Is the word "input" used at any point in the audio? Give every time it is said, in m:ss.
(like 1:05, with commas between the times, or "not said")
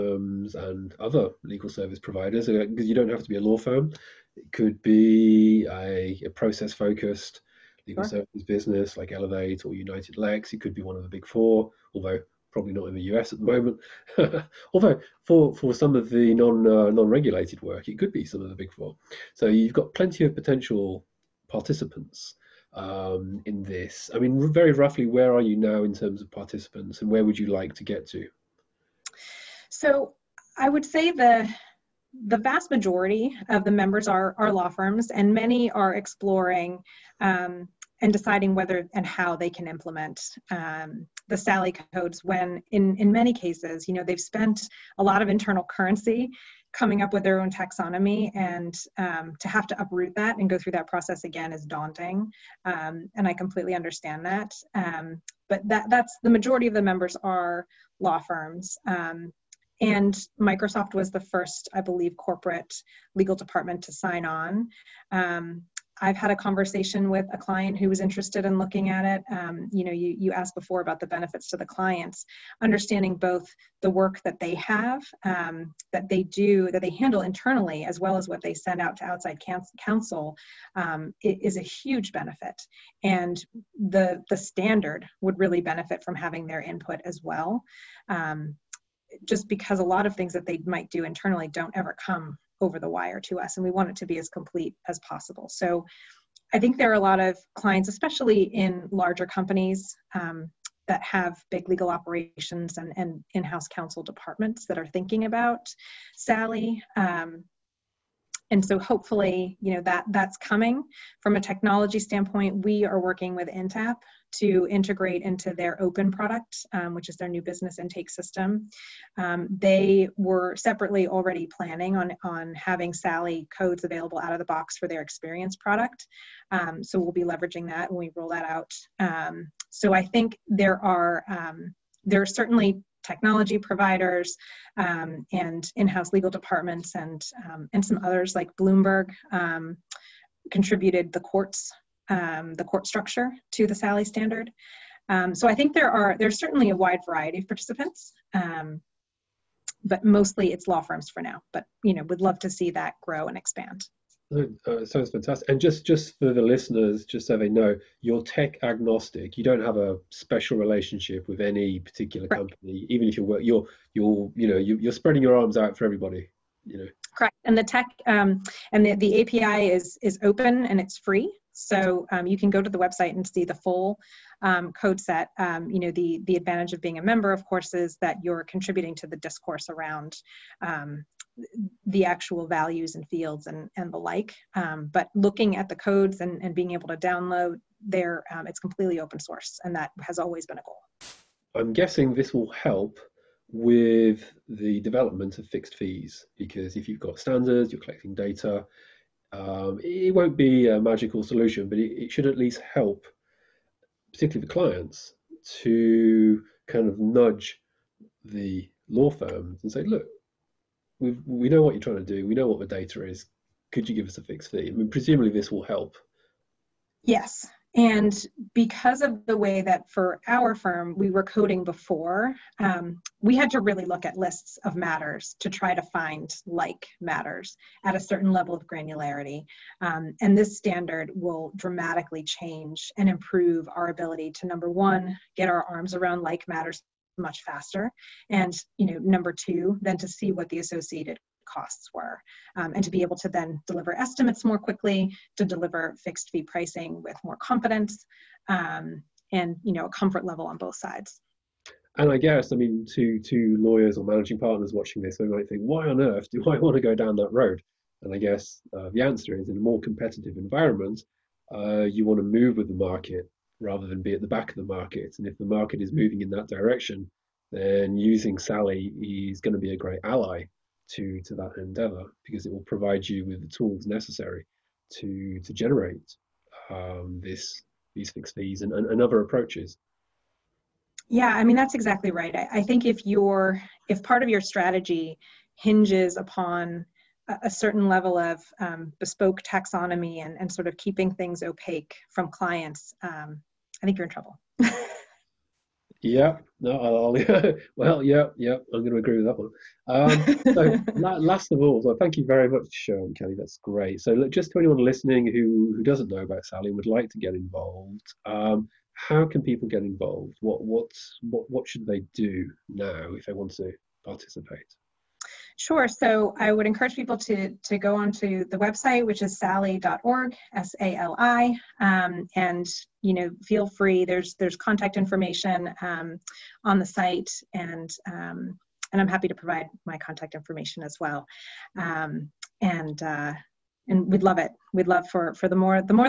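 1:26.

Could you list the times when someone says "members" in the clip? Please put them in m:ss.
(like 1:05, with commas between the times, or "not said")
0:33, 0:56, 2:57.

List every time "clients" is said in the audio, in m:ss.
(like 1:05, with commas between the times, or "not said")
1:07, 1:11, 1:37, 3:24, 4:52.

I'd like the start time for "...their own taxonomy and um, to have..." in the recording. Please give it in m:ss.
0:47.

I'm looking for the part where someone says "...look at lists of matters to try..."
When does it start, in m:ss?
3:43.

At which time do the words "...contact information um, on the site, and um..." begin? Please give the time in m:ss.
5:24.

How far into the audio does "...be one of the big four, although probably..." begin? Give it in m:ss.
0:10.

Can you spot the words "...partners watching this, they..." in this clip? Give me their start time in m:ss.
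4:14.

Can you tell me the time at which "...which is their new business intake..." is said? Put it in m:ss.
1:56.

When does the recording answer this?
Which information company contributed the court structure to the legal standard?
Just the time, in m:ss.
2:18.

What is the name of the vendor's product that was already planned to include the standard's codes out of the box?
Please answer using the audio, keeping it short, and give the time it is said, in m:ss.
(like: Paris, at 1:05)
experience, at 2:05.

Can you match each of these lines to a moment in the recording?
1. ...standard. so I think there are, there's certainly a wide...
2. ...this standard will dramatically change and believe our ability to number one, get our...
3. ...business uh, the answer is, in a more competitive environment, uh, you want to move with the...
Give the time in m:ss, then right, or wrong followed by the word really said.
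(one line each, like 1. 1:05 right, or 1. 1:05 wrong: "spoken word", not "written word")
1. 2:24 right
2. 3:50 wrong: "improve", not "believe"
3. 4:18 wrong: "guess", not "business".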